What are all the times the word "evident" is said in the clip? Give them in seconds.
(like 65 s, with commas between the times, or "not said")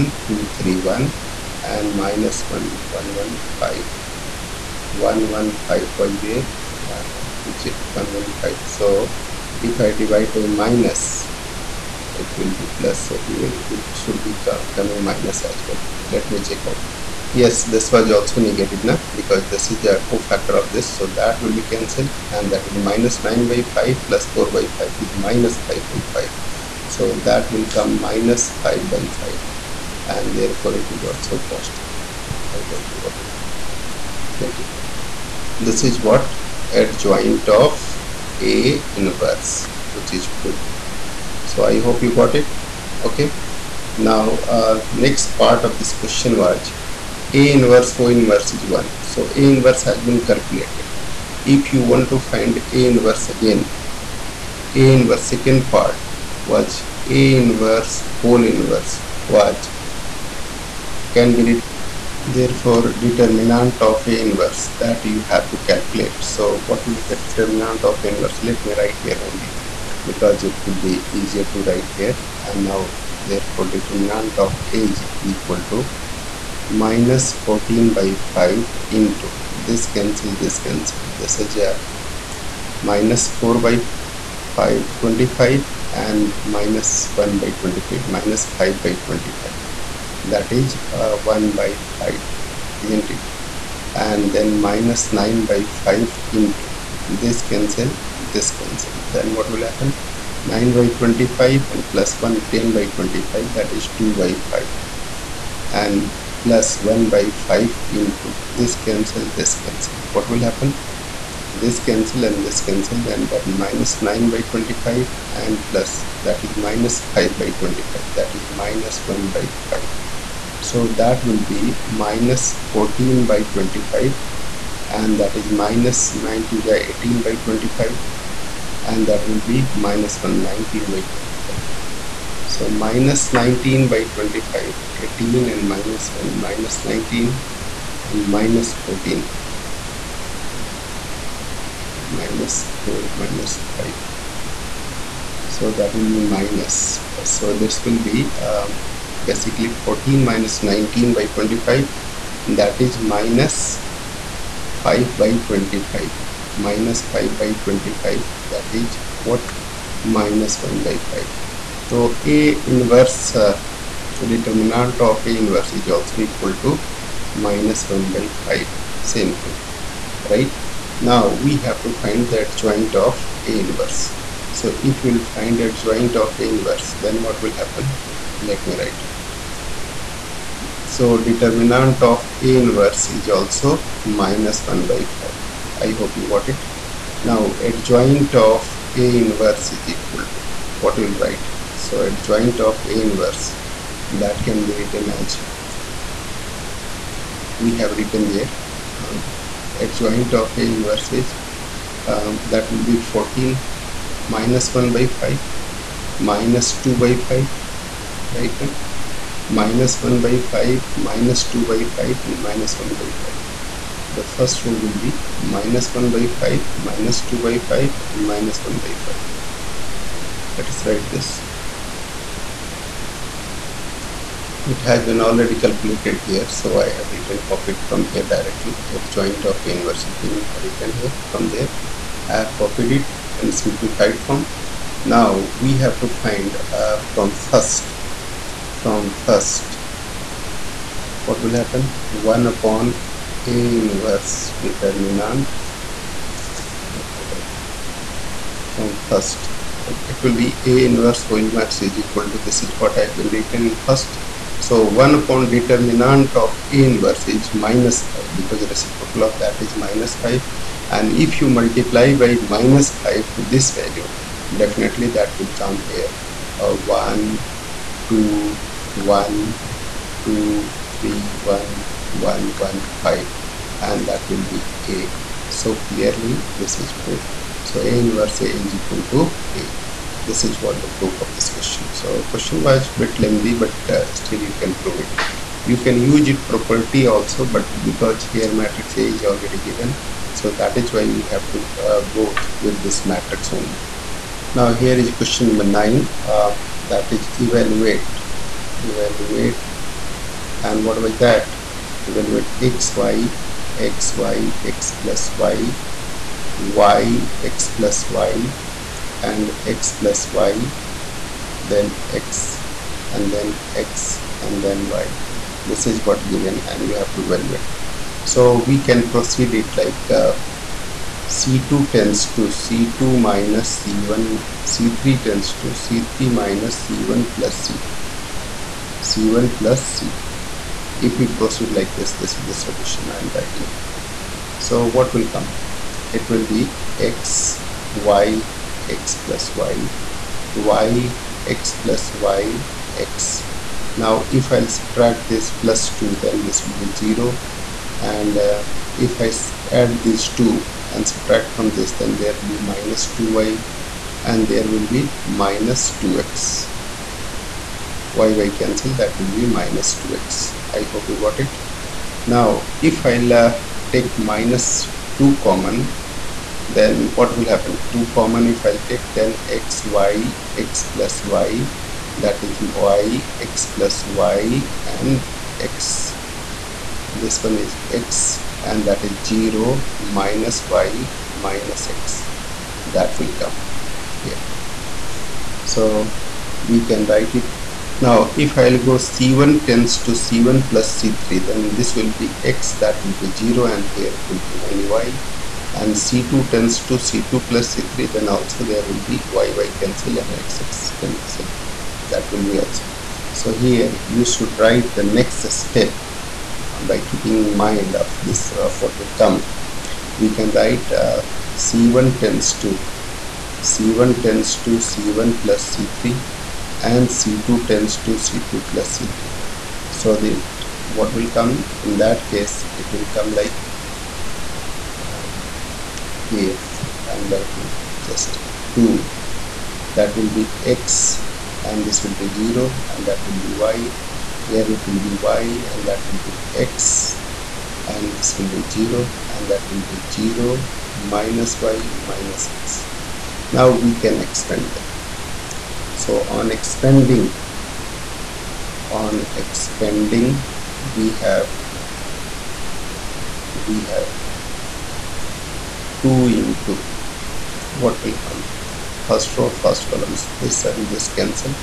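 not said.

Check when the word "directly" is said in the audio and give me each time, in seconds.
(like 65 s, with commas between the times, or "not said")
228 s.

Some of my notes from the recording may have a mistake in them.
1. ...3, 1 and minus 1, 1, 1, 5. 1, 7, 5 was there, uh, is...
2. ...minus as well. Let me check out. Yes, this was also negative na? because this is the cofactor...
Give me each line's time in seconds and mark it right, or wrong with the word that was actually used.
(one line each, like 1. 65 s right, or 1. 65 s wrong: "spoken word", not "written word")
1. 0 s wrong: "1", not "7"
2. 15 s right.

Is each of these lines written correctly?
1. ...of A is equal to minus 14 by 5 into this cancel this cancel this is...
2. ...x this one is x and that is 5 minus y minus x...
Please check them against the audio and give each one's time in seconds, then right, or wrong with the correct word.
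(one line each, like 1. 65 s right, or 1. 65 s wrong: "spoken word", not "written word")
1. 74 s right
2. 375 s wrong: "0", not "5".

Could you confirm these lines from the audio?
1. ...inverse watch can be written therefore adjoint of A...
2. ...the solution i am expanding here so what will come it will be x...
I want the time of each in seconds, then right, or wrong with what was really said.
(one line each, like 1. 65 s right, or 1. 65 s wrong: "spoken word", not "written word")
1. 58 s wrong: "determinant", not "adjoint"
2. 332 s wrong: "writing", not "expanding".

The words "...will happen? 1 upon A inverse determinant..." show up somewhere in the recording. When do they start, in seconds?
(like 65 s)
241 s.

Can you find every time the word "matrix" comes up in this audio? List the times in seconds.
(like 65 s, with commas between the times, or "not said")
288 s, 293 s.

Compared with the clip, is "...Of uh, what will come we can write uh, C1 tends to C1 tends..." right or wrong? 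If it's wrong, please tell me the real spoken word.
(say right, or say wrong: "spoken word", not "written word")
right.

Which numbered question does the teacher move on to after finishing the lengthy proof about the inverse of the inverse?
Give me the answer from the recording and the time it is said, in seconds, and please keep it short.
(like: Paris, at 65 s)
9, at 295 s.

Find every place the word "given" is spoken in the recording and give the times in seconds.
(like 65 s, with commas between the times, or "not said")
289 s, 316 s.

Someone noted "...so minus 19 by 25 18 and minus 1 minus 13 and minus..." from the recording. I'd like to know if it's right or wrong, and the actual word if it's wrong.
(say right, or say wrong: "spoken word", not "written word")
wrong: "19", not "13".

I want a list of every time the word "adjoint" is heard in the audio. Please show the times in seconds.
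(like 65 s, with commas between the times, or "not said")
36 s, 175 s, 187 s, 192 s, 199 s.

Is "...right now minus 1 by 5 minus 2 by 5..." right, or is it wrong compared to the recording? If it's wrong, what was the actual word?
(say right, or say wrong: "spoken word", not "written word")
right.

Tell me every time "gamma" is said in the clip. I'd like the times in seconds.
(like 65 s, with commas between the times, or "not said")
not said.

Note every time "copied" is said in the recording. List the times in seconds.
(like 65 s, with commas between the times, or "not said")
227 s, 232 s.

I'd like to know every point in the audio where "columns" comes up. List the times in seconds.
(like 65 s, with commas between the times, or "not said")
459 s.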